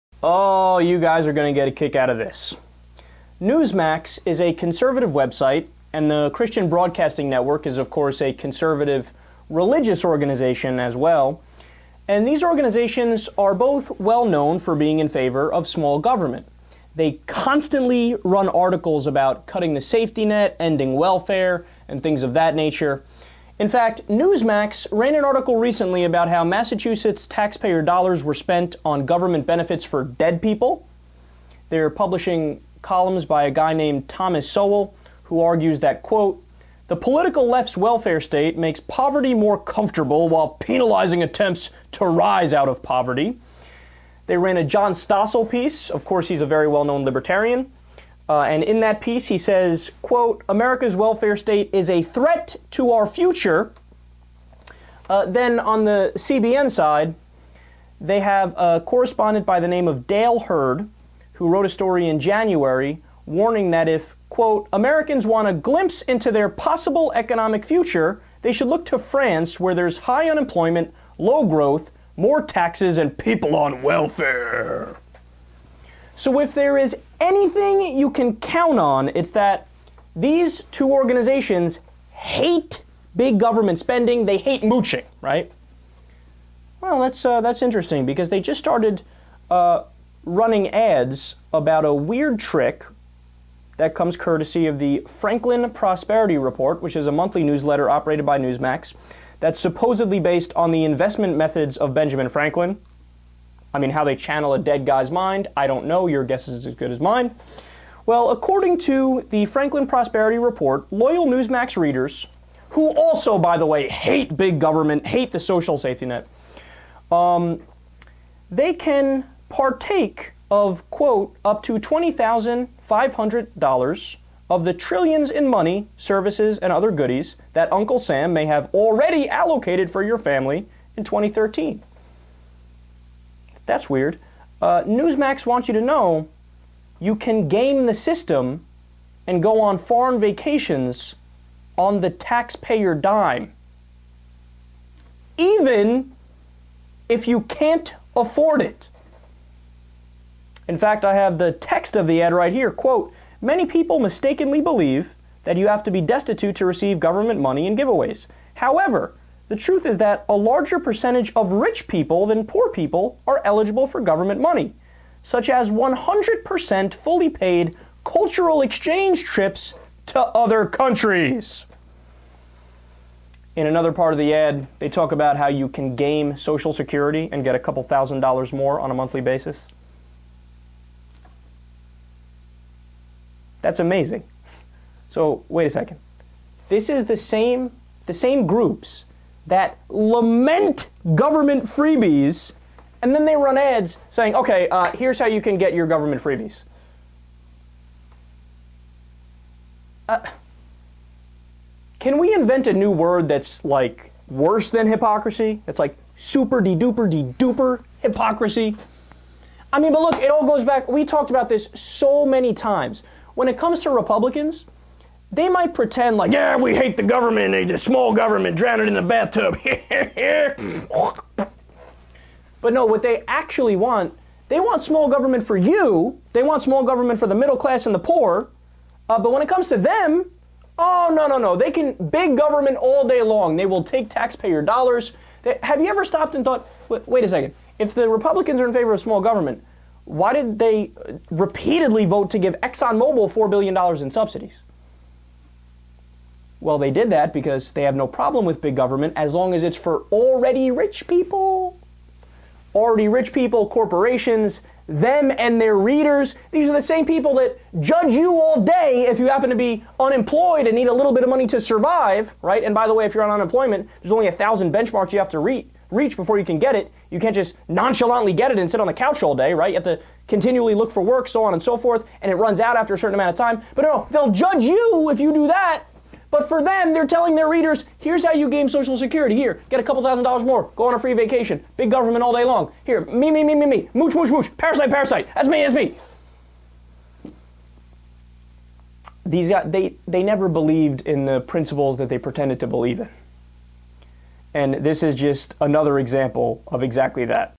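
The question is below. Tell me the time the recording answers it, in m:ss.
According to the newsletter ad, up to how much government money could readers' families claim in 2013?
2:01.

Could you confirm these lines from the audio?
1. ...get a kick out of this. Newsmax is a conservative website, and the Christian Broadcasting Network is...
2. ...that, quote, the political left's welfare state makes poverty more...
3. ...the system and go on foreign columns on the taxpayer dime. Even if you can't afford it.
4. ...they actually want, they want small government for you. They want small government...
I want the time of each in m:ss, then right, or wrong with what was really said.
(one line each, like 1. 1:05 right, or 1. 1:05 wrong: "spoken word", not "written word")
1. 0:01 right
2. 0:35 right
3. 2:17 wrong: "vacations", not "columns"
4. 3:43 right.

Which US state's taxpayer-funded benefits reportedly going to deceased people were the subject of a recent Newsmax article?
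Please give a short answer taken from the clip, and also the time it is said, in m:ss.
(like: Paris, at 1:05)
Massachusetts, at 0:26.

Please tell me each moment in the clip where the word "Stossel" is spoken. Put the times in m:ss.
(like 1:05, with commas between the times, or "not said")
0:44.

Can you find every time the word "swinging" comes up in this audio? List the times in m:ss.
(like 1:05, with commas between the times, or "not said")
not said.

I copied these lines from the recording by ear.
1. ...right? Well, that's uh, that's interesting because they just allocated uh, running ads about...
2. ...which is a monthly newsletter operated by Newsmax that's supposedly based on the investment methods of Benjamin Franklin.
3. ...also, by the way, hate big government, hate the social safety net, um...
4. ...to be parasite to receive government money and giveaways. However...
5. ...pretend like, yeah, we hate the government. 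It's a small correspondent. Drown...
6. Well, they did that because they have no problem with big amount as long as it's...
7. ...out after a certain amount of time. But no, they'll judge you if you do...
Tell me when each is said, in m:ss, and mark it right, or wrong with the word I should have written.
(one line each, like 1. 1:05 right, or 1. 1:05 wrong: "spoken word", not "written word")
1. 1:25 wrong: "started", not "allocated"
2. 1:36 right
3. 1:52 right
4. 2:35 wrong: "destitute", not "parasite"
5. 3:35 wrong: "government", not "correspondent"
6. 4:06 wrong: "government", not "amount"
7. 4:32 right.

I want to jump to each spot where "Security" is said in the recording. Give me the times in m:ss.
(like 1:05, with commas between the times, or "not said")
2:56, 4:38.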